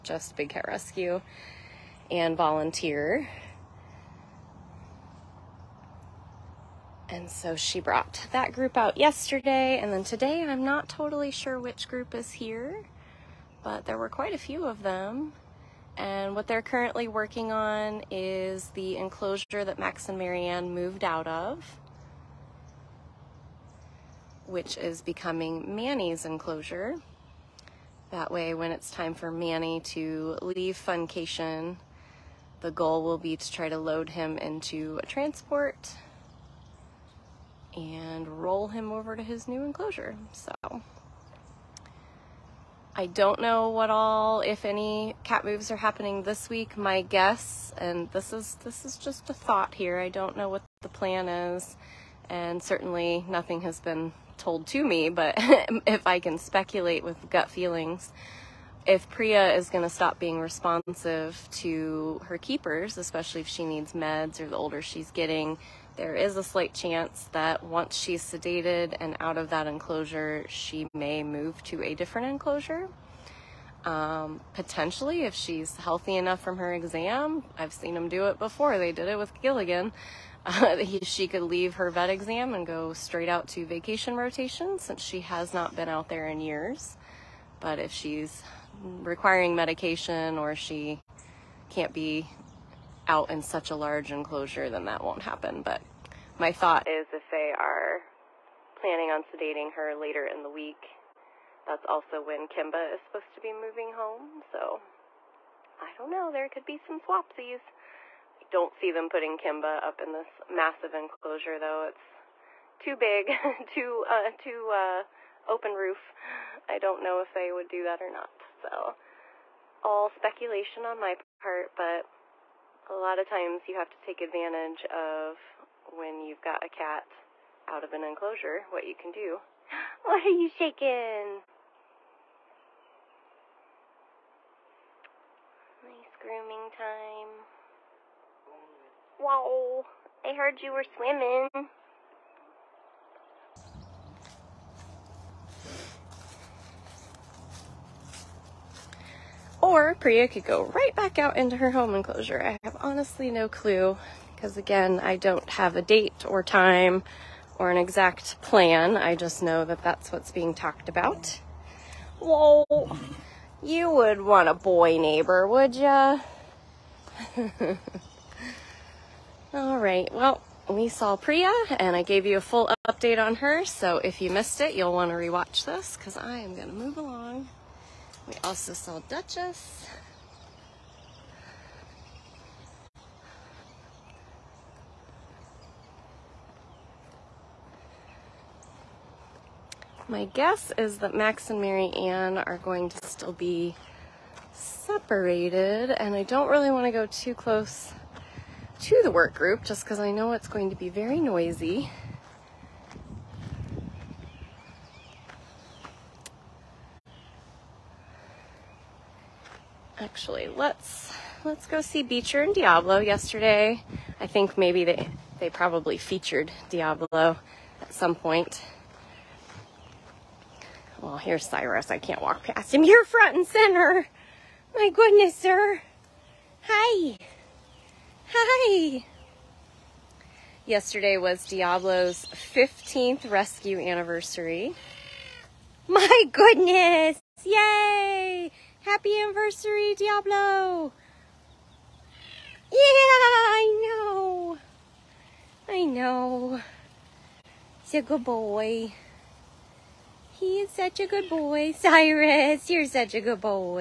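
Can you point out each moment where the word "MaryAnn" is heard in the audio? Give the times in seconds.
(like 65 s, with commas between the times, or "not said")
20 s, 191 s.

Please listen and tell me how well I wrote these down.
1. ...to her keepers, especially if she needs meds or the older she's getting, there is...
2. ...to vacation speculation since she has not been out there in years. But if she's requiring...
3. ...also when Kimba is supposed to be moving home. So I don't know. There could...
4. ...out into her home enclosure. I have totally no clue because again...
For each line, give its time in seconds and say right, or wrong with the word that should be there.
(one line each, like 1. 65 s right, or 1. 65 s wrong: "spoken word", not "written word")
1. 61 s right
2. 83 s wrong: "rotation", not "speculation"
3. 101 s right
4. 151 s wrong: "honestly", not "totally".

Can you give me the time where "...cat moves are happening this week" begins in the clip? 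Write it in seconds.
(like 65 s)
45 s.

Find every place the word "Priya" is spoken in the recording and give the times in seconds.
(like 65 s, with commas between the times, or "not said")
59 s, 149 s, 171 s.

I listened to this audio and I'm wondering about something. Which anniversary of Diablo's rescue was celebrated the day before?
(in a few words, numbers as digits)
15th.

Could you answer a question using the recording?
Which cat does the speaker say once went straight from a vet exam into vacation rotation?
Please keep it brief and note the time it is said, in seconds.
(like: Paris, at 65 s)
Gilligan, at 79 s.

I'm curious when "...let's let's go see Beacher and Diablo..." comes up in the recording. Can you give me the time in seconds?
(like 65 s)
210 s.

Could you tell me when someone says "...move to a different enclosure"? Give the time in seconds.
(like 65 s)
71 s.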